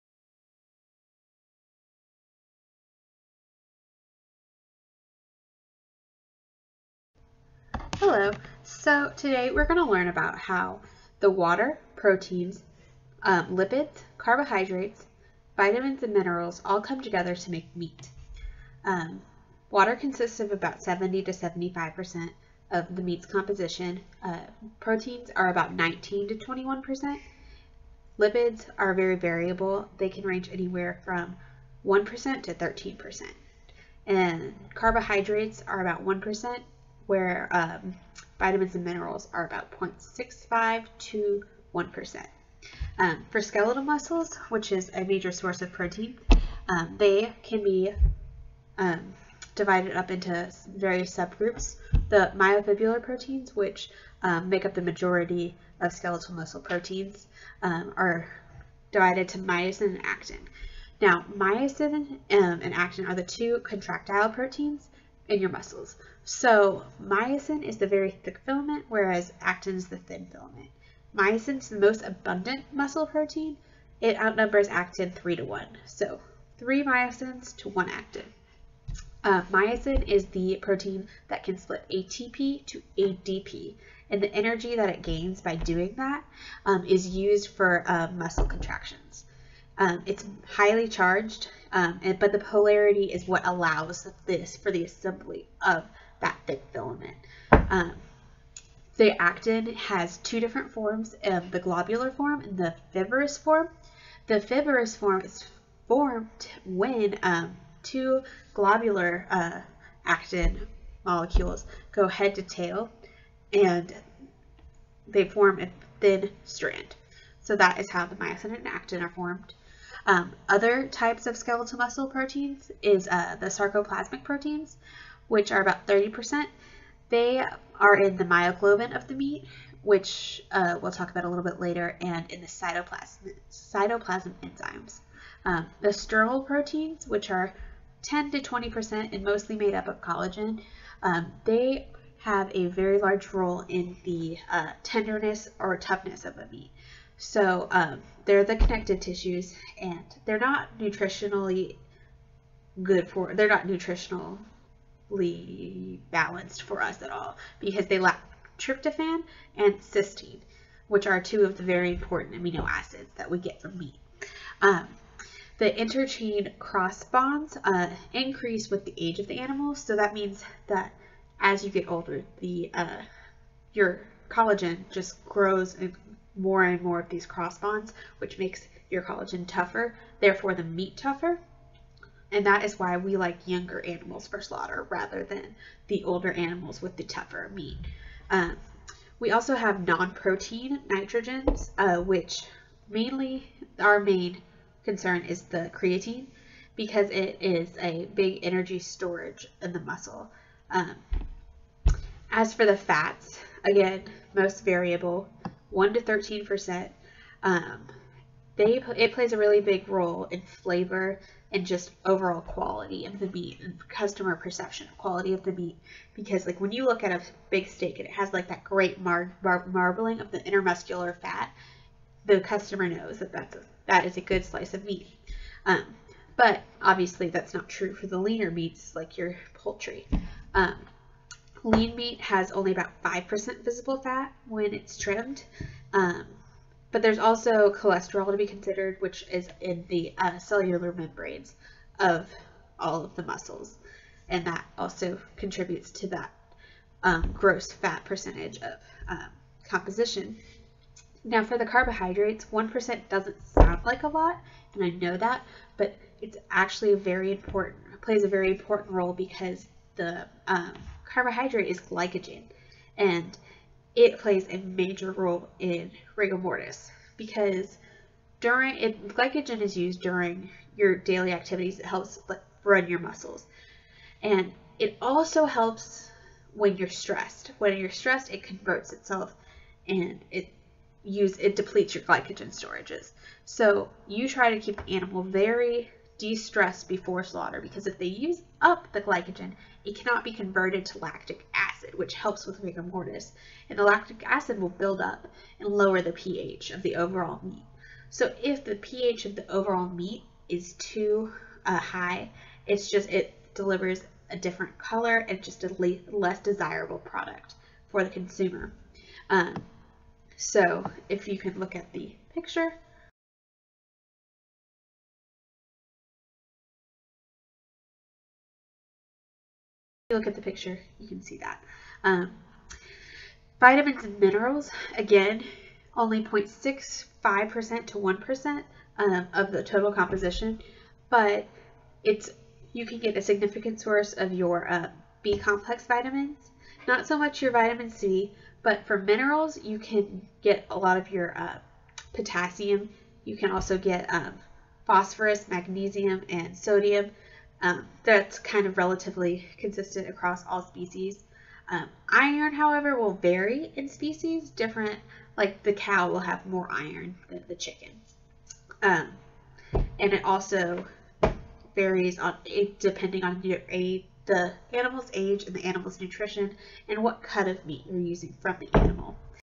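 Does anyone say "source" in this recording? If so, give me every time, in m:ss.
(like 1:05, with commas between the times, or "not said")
0:45, 5:33.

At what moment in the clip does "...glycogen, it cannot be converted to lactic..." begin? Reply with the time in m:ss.
4:49.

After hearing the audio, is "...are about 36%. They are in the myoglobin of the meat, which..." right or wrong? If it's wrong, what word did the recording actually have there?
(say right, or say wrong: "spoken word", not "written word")
wrong: "30", not "36".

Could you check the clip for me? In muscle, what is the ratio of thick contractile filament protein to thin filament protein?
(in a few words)
3 to 1.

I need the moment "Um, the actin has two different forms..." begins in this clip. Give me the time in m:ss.
1:37.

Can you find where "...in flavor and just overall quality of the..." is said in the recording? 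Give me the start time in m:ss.
3:30.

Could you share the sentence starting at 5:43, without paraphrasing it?
You can also get um, phosphorus, magnesium, and sodium.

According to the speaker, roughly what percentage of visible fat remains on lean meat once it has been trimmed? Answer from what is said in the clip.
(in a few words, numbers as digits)
5%.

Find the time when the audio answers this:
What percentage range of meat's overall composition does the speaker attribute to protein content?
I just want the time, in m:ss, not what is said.
0:25.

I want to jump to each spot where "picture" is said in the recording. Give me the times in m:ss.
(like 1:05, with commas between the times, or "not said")
5:12, 5:20.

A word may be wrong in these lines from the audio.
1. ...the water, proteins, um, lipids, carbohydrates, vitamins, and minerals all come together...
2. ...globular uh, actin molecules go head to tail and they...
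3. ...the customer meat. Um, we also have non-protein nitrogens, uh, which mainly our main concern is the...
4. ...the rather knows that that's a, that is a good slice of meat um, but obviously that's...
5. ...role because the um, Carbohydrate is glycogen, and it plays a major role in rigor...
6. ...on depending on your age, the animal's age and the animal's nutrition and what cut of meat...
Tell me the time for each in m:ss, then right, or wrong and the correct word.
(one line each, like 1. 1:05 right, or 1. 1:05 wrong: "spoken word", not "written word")
1. 0:11 right
2. 1:48 right
3. 3:06 wrong: "tougher", not "customer"
4. 3:42 wrong: "customer", not "rather"
5. 4:18 right
6. 6:02 right.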